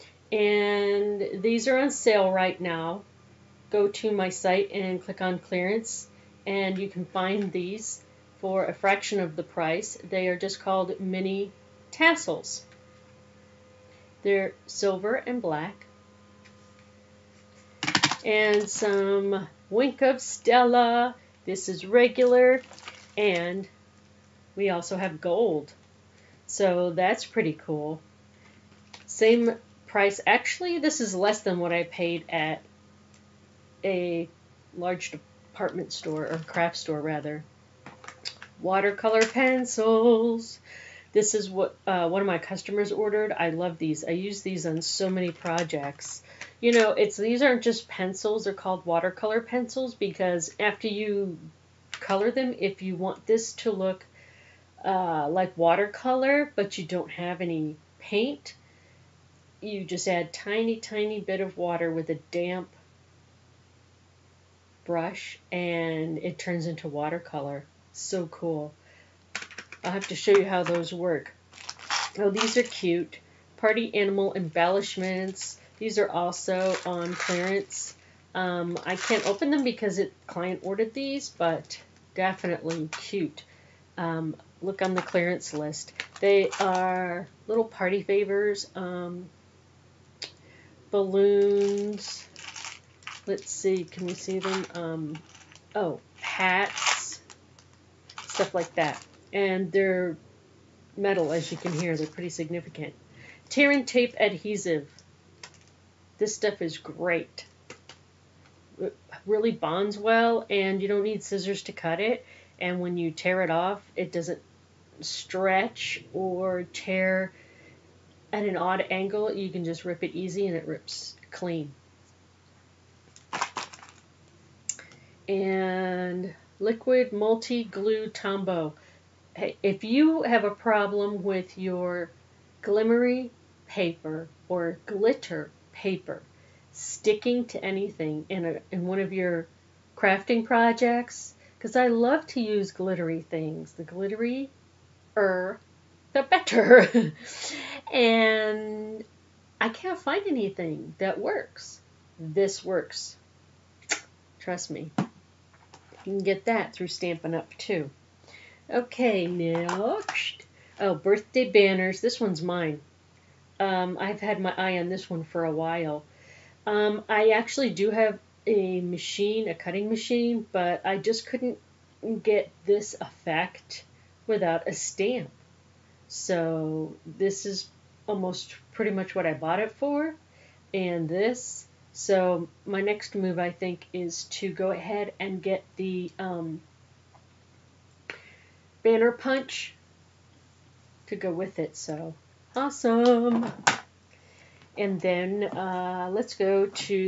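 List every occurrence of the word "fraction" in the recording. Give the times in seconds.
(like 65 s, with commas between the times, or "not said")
8 s.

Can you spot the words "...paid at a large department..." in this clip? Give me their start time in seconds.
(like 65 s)
31 s.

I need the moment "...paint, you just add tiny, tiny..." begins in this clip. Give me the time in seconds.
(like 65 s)
57 s.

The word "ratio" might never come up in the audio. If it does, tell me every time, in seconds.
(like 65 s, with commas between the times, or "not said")
not said.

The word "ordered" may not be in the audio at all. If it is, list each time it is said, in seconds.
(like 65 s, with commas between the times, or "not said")
42 s, 80 s.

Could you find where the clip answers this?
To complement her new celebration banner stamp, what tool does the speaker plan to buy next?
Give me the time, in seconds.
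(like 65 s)
188 s.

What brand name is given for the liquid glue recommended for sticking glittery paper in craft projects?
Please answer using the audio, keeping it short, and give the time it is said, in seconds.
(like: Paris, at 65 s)
Tombow, at 128 s.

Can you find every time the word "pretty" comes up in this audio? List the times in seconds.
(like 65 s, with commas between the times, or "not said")
27 s, 102 s, 178 s.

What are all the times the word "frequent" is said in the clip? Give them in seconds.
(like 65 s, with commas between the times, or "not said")
not said.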